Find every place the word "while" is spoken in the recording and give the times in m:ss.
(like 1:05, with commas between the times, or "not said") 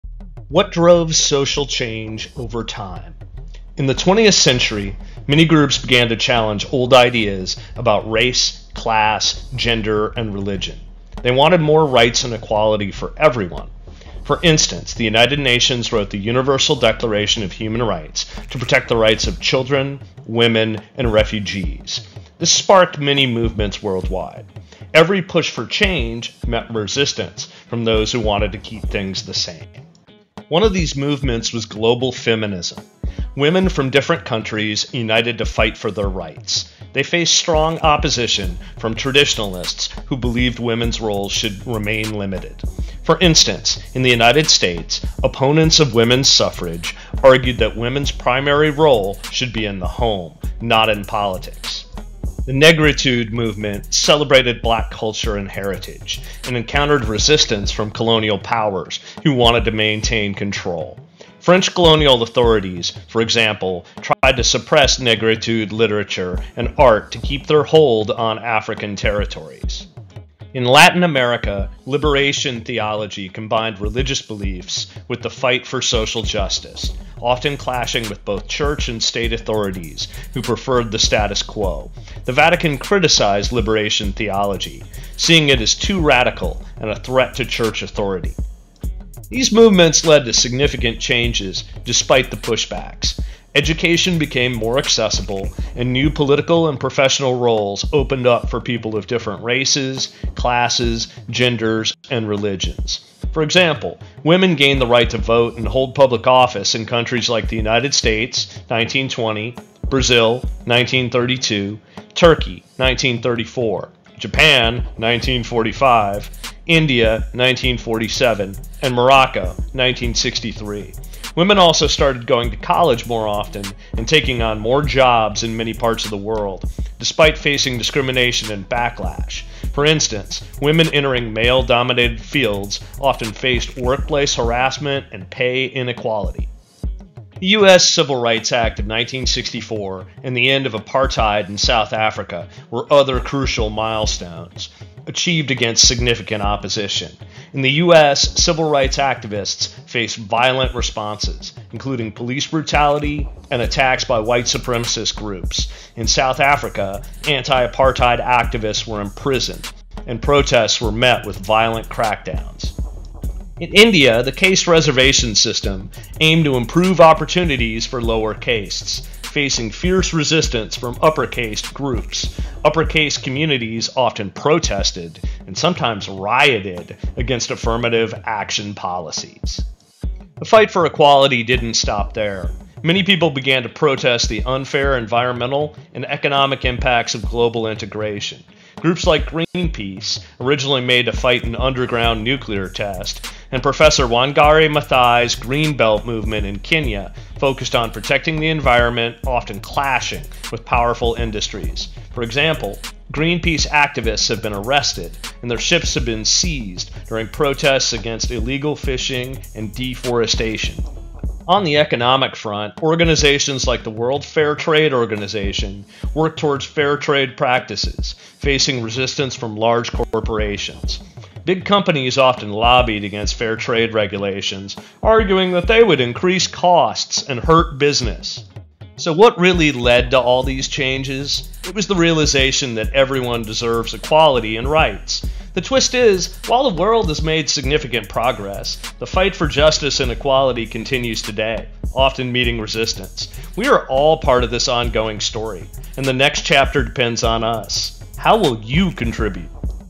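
3:56.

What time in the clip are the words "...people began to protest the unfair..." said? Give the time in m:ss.
3:03.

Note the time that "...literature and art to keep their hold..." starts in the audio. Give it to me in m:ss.
1:05.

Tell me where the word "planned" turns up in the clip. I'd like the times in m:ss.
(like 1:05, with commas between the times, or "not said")
not said.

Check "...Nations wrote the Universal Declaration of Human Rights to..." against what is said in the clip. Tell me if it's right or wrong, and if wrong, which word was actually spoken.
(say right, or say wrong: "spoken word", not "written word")
right.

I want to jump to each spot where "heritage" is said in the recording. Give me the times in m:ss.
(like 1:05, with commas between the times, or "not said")
0:55.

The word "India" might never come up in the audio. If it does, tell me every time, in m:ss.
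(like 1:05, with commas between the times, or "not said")
1:56, 2:43.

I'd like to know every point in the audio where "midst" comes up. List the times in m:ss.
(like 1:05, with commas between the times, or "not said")
not said.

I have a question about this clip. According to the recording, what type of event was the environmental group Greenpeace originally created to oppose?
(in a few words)
Underground nuclear test.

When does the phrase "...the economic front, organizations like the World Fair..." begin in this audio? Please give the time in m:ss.
3:31.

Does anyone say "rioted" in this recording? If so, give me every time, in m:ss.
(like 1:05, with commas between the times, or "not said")
2:56.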